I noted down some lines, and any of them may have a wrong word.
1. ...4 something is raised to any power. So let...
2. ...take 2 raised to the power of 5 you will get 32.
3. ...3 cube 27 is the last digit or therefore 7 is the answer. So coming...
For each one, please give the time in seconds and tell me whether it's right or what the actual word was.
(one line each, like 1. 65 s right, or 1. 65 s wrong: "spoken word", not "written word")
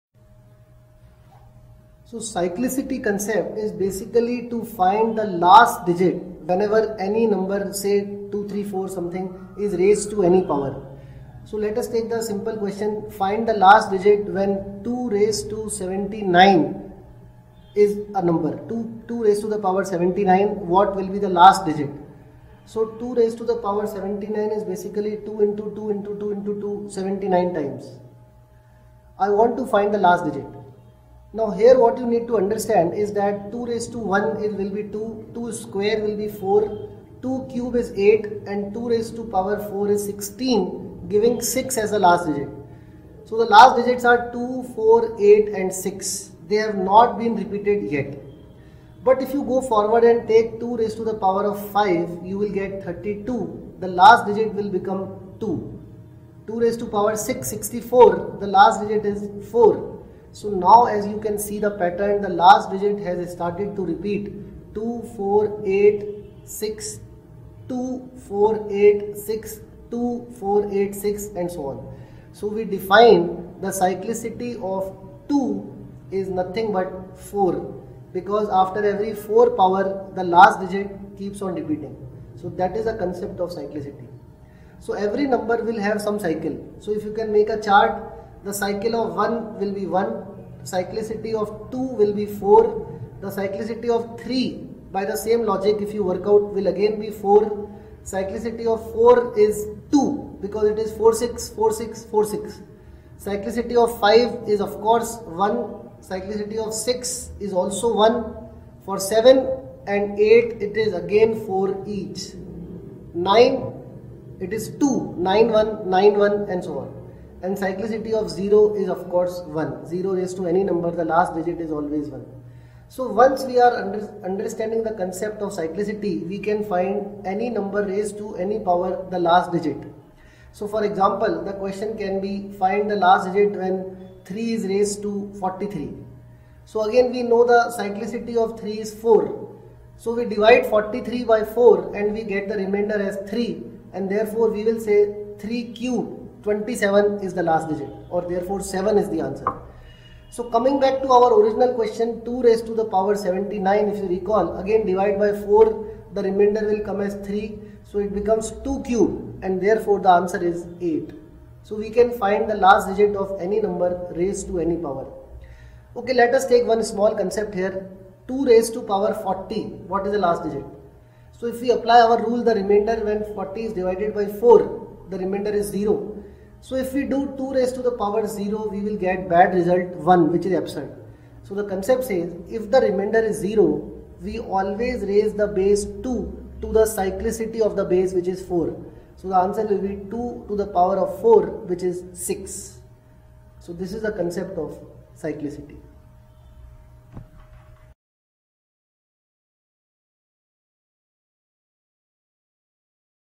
1. 8 s right
2. 50 s right
3. 145 s right.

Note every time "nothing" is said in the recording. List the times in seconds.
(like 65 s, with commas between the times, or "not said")
76 s.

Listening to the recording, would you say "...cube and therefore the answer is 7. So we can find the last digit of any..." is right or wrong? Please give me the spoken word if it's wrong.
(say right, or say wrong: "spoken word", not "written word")
wrong: "8", not "7".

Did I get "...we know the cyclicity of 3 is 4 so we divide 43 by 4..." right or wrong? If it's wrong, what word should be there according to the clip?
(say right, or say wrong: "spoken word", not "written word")
right.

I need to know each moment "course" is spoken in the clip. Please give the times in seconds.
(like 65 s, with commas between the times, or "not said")
104 s, 119 s.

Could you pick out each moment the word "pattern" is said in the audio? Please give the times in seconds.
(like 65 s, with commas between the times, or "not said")
61 s.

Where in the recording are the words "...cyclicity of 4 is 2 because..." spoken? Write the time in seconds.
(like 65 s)
98 s.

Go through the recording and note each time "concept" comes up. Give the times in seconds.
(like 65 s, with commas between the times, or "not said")
3 s, 82 s, 124 s, 167 s, 181 s, 194 s.